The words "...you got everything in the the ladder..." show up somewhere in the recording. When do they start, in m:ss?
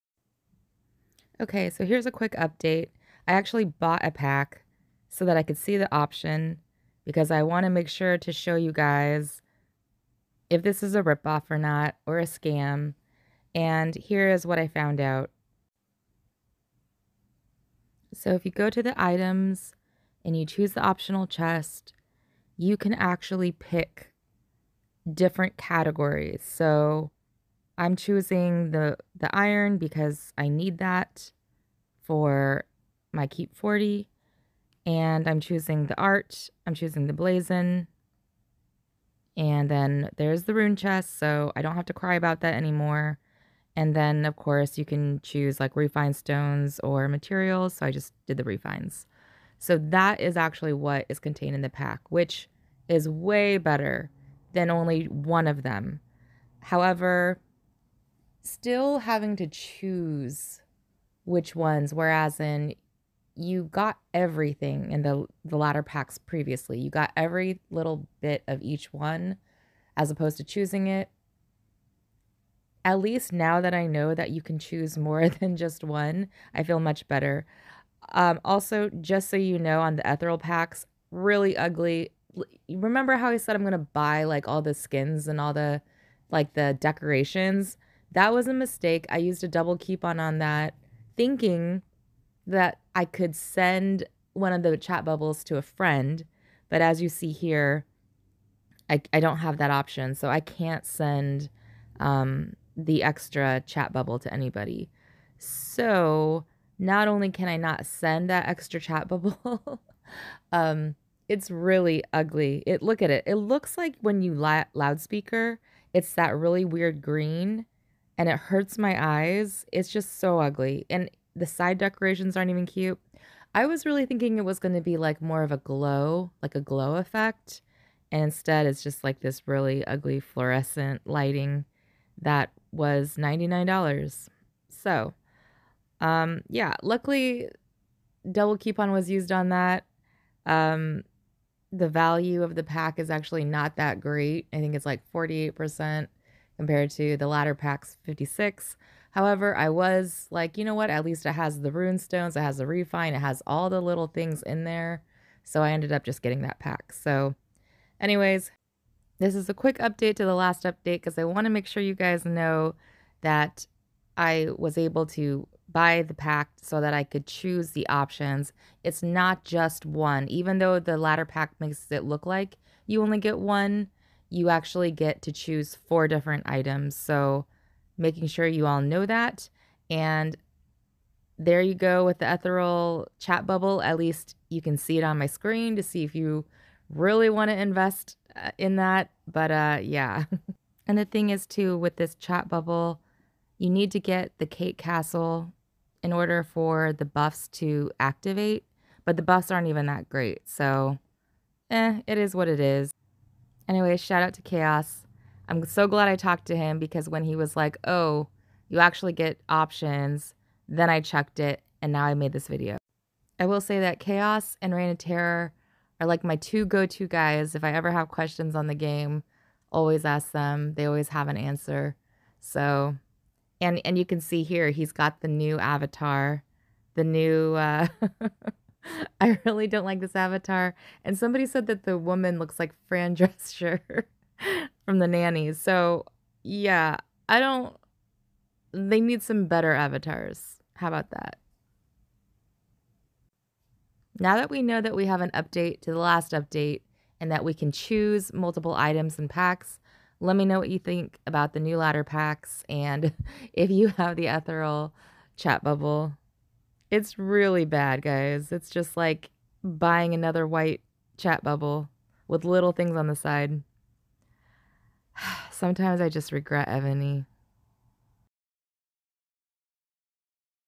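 1:03.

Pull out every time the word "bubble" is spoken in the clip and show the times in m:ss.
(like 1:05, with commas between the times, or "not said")
1:35, 1:43, 1:49, 3:03, 3:12, 4:15, 4:21.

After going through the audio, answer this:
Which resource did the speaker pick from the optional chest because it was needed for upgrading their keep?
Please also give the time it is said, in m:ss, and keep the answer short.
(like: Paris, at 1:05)
Iron, at 0:29.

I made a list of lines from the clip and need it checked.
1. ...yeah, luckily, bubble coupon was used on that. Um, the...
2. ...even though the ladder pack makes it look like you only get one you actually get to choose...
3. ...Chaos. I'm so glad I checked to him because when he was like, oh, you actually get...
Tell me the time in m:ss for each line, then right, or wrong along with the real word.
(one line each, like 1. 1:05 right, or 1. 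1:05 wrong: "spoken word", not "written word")
1. 2:16 wrong: "double", not "bubble"
2. 2:50 right
3. 3:24 wrong: "talked", not "checked".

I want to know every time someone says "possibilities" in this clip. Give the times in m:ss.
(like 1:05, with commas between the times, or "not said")
not said.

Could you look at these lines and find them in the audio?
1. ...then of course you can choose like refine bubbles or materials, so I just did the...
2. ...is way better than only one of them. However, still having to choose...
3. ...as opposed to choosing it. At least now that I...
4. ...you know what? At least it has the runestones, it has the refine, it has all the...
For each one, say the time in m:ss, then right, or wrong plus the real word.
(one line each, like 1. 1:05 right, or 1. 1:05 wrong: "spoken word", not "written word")
1. 0:43 wrong: "stones", not "bubbles"
2. 0:52 right
3. 1:09 right
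4. 2:30 right.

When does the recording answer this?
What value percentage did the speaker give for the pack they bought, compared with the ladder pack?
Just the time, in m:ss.
2:25.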